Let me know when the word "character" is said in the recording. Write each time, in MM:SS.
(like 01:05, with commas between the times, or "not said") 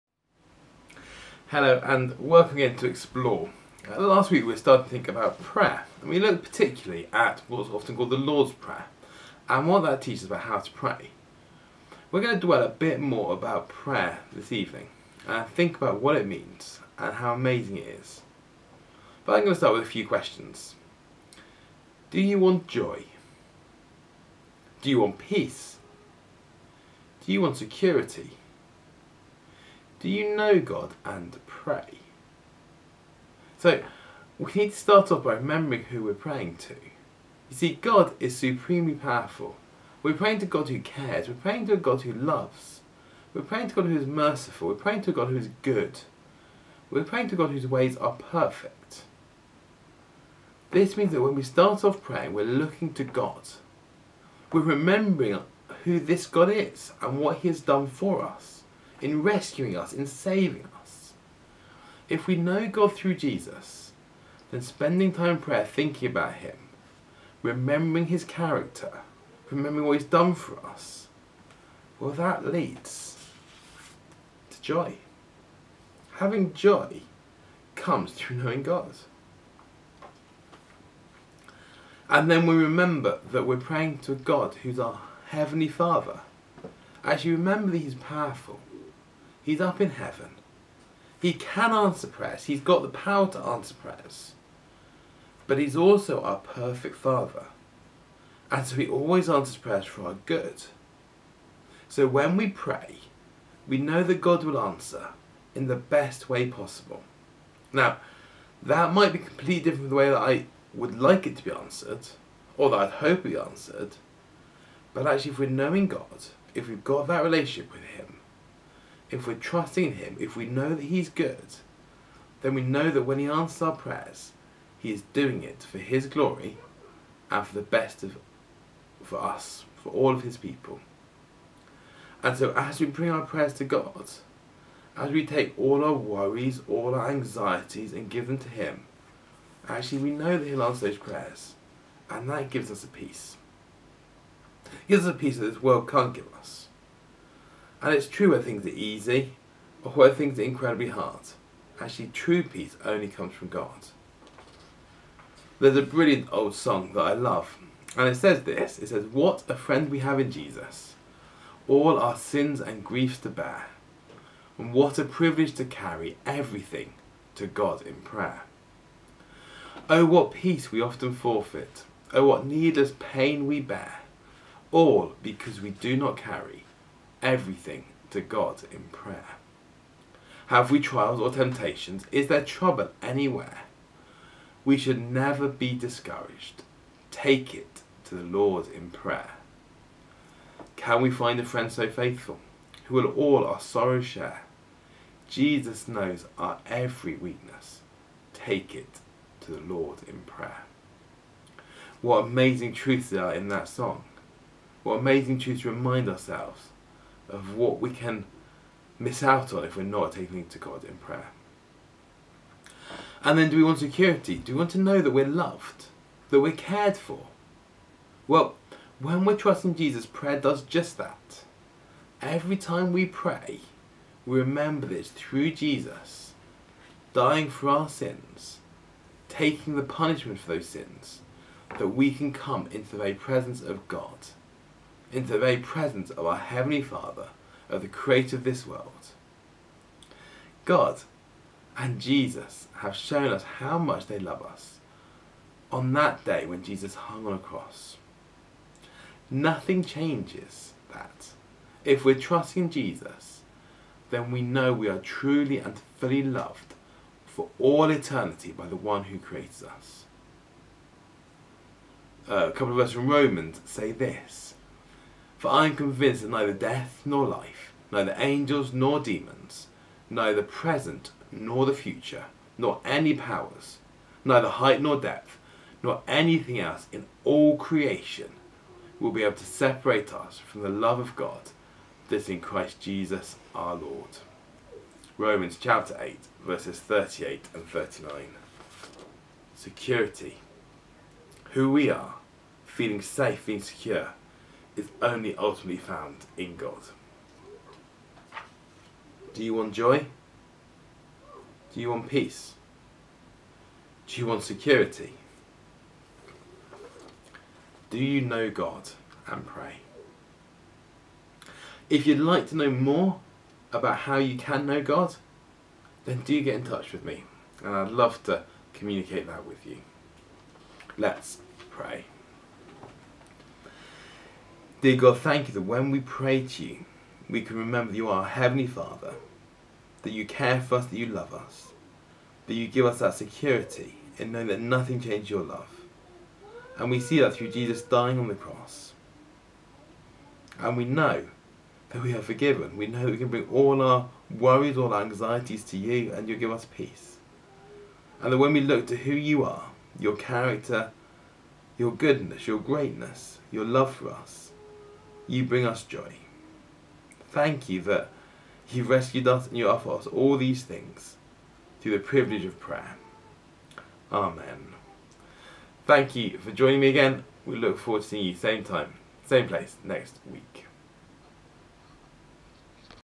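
01:08, 05:50.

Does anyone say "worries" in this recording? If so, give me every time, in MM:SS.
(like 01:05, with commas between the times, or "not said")
02:15, 05:44.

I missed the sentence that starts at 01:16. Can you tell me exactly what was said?
Having joy comes through knowing God.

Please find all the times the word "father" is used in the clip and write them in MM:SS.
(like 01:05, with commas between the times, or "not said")
01:25, 01:36, 03:56, 05:28.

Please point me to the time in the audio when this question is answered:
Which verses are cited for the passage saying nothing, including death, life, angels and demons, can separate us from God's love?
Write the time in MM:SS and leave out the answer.
04:46.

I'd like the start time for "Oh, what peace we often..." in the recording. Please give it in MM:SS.
02:49.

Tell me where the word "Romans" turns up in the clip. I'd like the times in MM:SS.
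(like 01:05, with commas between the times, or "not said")
04:23, 04:45.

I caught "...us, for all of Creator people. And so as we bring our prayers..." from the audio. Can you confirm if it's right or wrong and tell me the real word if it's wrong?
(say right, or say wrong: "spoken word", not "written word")
wrong: "His", not "Creator".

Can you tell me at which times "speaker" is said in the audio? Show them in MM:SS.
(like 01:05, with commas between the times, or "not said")
not said.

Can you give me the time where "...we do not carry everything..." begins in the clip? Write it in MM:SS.
02:55.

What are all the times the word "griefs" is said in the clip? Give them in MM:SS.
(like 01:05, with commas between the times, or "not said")
02:42.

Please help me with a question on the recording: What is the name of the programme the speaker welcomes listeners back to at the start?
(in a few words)
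Explore.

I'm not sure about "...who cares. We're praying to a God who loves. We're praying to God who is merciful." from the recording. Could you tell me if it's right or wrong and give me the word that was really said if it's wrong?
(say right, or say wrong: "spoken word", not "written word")
right.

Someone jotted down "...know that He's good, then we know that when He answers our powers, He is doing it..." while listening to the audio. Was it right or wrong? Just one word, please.
wrong.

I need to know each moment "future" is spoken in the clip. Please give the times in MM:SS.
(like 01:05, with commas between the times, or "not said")
04:31.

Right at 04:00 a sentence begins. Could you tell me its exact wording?
God and Jesus have shown us how much they love us on that day when Jesus hung on a cross.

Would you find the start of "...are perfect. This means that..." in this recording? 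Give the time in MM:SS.
00:47.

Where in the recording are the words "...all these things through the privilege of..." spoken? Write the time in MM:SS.
06:00.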